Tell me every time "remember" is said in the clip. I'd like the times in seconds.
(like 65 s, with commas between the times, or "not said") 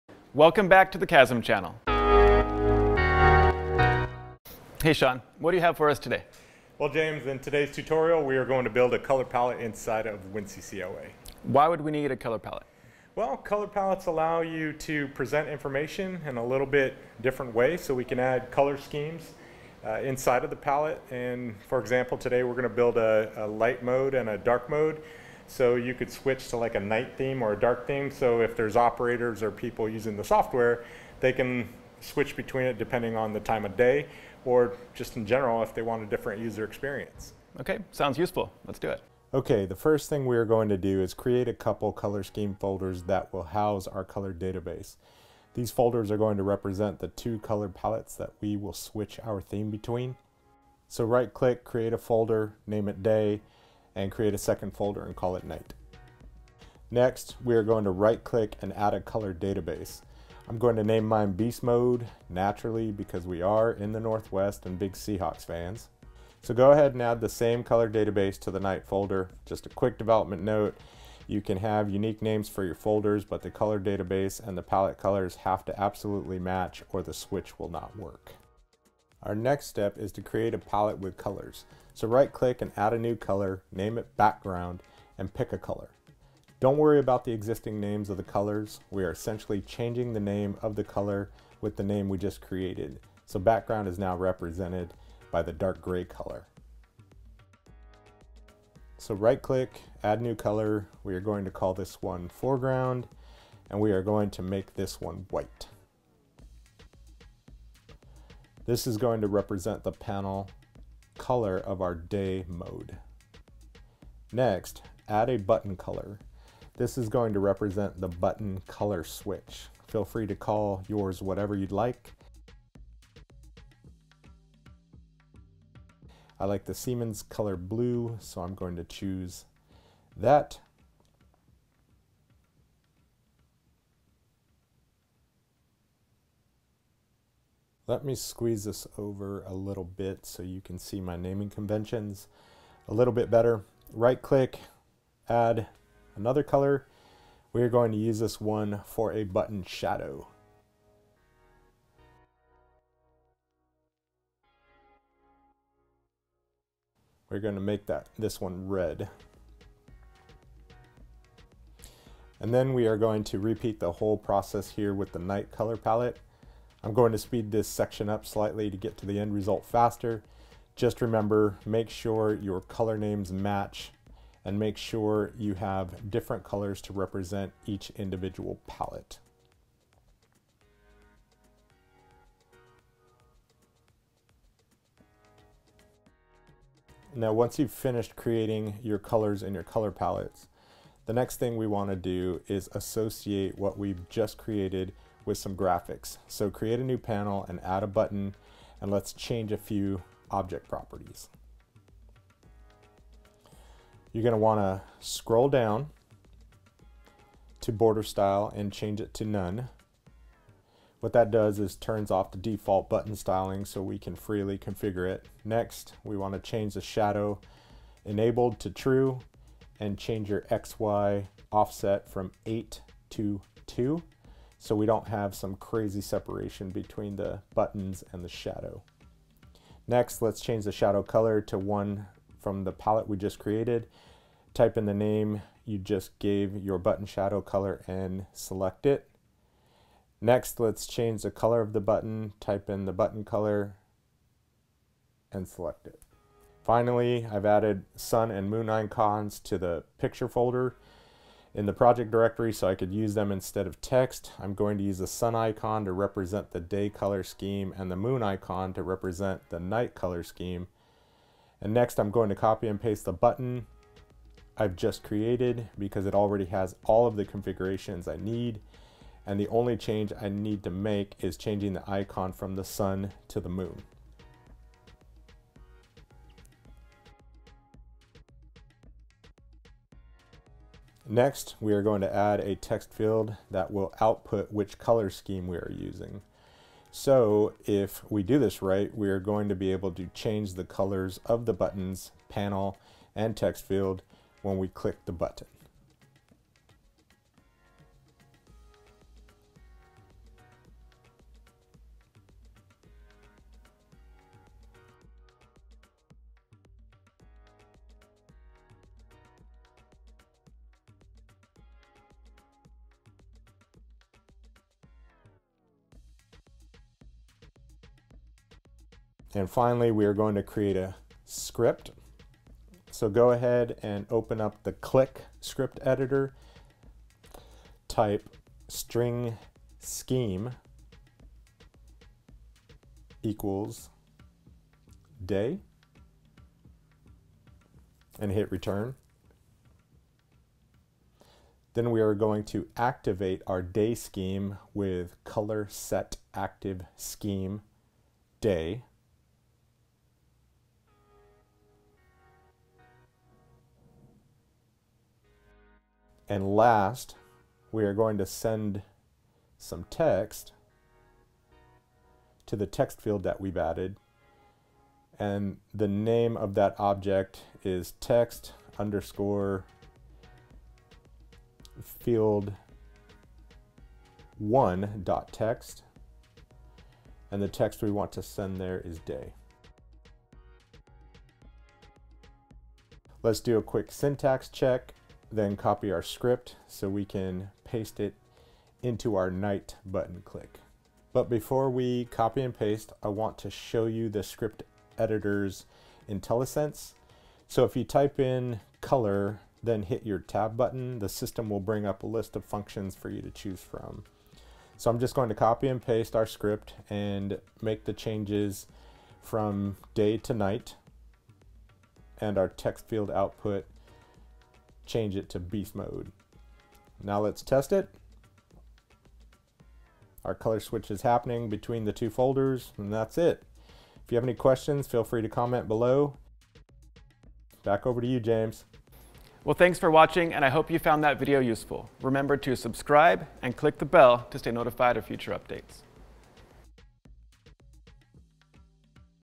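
171 s, 432 s.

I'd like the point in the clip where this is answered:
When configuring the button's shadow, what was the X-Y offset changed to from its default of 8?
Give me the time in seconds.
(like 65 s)
223 s.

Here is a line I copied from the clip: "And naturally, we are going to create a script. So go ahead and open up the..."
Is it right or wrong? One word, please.
wrong.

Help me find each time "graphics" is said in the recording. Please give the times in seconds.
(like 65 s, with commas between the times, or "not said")
195 s.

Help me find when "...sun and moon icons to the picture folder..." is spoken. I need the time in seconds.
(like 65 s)
247 s.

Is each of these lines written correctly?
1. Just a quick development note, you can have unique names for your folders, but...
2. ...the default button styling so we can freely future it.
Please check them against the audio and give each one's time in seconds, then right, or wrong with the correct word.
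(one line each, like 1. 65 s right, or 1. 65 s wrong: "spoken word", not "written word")
1. 69 s right
2. 212 s wrong: "configure", not "future".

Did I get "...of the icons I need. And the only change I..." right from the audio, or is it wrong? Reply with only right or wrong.
wrong.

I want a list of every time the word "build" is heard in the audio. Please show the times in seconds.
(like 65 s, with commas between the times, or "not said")
8 s, 22 s.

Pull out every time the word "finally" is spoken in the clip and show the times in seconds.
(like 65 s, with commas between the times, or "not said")
246 s, 319 s.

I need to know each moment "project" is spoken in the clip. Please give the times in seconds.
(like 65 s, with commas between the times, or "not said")
251 s.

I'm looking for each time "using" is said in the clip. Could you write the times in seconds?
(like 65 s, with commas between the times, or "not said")
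29 s, 285 s.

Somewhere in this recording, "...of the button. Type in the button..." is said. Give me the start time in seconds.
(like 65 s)
241 s.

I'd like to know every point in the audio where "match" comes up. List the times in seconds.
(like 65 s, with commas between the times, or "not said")
76 s, 173 s.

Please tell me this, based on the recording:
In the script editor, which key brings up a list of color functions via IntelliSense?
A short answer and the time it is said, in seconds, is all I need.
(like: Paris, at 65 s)
tab, at 400 s.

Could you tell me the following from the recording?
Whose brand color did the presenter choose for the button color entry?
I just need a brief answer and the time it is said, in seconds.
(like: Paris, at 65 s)
Siemens, at 126 s.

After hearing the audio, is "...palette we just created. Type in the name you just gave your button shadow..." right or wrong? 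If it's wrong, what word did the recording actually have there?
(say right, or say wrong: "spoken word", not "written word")
right.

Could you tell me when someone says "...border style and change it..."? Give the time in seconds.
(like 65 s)
207 s.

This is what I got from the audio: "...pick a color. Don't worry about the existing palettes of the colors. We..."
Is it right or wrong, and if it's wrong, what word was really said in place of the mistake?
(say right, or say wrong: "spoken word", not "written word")
wrong: "names", not "palettes".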